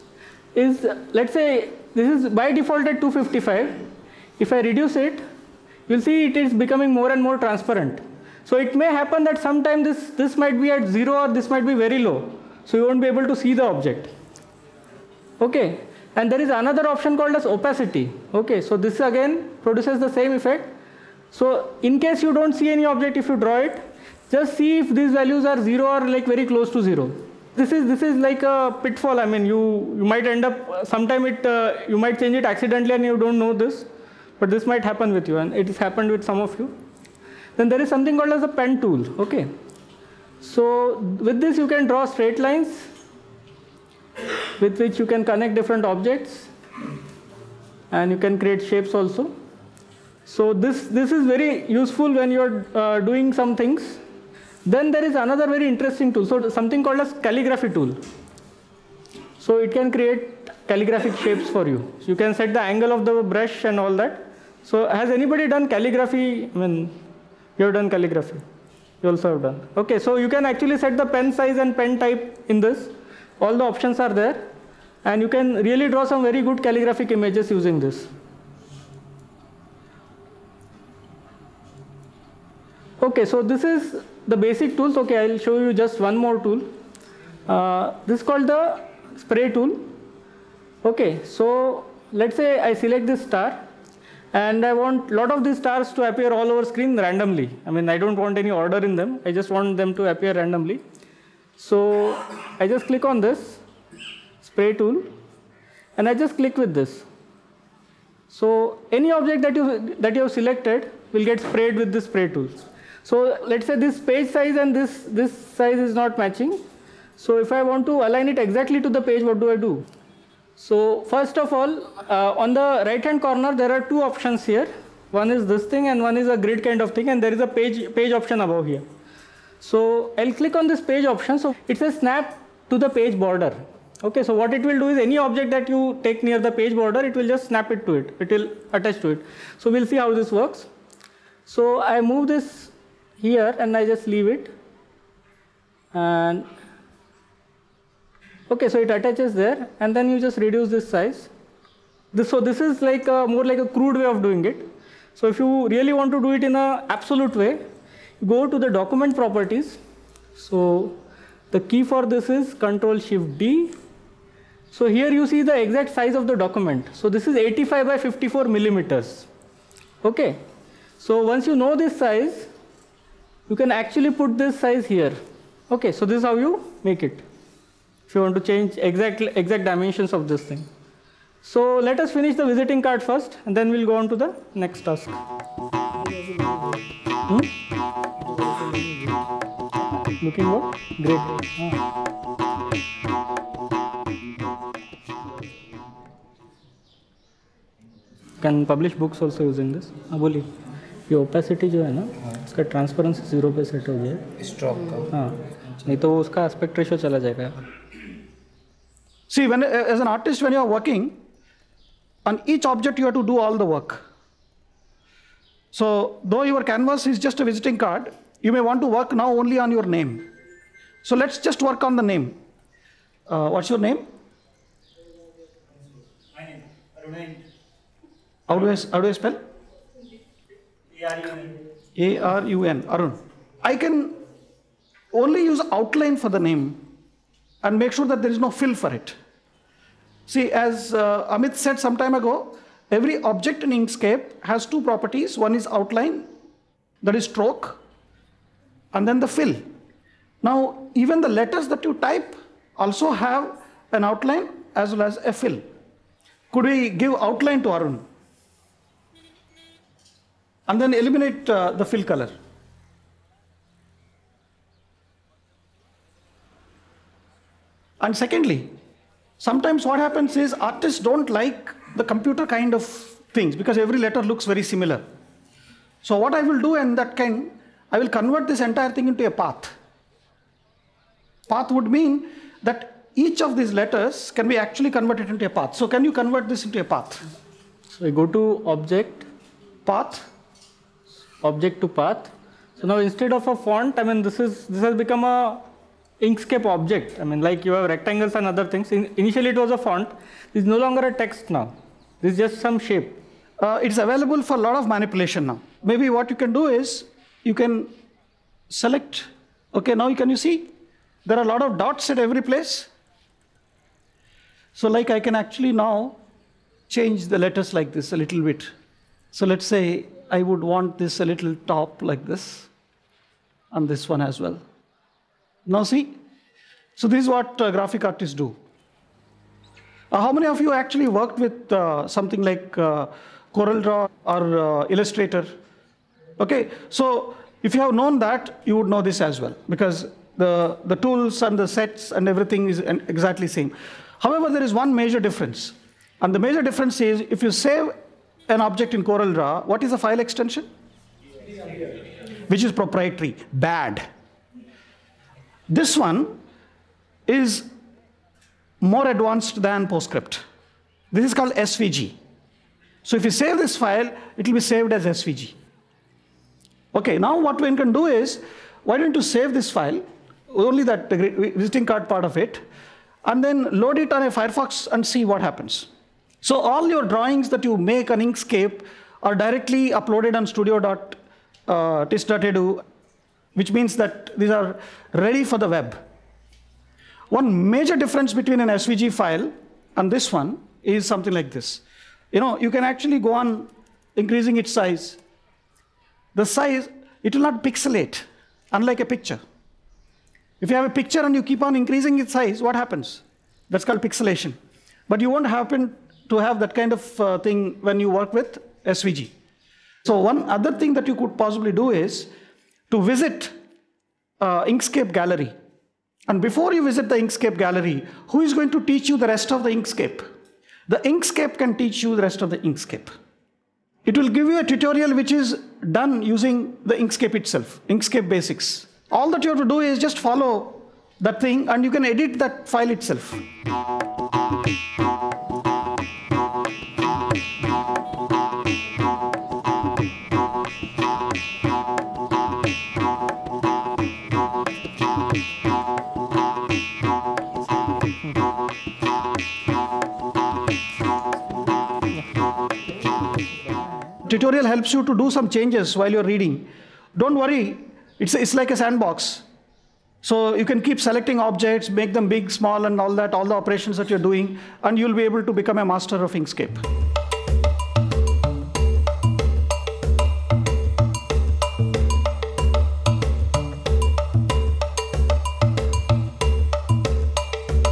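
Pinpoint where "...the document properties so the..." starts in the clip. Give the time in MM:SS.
02:38.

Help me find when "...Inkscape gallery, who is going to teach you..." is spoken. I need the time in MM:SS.
06:57.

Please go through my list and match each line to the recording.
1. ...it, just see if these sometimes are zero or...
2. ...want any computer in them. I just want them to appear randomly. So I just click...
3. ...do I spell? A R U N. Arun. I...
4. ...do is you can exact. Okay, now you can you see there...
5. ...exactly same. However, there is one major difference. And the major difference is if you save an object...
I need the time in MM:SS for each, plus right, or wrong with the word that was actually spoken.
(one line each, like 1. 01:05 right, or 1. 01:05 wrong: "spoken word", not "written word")
1. 00:23 wrong: "values", not "sometimes"
2. 01:38 wrong: "order", not "computer"
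3. 03:49 right
4. 05:06 wrong: "select", not "exact"
5. 05:42 right.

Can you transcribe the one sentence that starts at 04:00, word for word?
See, as uh, Amit said some time ago, every object in Inkscape has two properties.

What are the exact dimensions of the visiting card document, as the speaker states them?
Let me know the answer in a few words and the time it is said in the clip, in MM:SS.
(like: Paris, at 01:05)
85 by 54 millimeters, at 02:47.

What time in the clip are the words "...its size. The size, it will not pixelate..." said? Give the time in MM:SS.
06:34.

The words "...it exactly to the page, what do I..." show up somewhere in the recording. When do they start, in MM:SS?
01:58.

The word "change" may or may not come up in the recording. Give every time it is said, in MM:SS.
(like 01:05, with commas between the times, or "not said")
00:32, 02:58, 05:16, 07:35.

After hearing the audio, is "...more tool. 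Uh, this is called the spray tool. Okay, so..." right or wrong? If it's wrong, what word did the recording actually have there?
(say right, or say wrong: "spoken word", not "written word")
right.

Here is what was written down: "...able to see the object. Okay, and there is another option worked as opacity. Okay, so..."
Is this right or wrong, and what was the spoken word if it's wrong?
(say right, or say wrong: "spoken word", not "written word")
wrong: "called", not "worked".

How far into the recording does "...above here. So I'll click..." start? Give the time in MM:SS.
02:08.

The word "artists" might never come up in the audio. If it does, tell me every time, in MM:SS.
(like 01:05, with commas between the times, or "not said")
04:30, 05:28.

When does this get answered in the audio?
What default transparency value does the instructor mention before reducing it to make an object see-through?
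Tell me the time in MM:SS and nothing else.
00:02.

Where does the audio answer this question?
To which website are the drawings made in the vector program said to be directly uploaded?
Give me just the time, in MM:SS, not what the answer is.
06:20.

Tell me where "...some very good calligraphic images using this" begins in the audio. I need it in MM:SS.
01:16.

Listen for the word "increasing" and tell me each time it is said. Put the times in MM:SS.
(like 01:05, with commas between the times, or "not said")
06:34, 06:41.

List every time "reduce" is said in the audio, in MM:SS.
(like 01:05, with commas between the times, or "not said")
00:04, 02:30.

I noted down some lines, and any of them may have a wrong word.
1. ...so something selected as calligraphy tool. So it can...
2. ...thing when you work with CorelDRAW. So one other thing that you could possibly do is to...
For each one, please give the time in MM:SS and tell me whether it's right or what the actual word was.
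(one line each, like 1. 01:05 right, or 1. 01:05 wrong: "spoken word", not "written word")
1. 00:56 wrong: "called", not "selected"
2. 06:47 wrong: "SVG", not "CorelDRAW".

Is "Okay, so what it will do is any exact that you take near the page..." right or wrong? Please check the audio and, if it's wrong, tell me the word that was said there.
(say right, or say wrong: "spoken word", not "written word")
wrong: "object", not "exact".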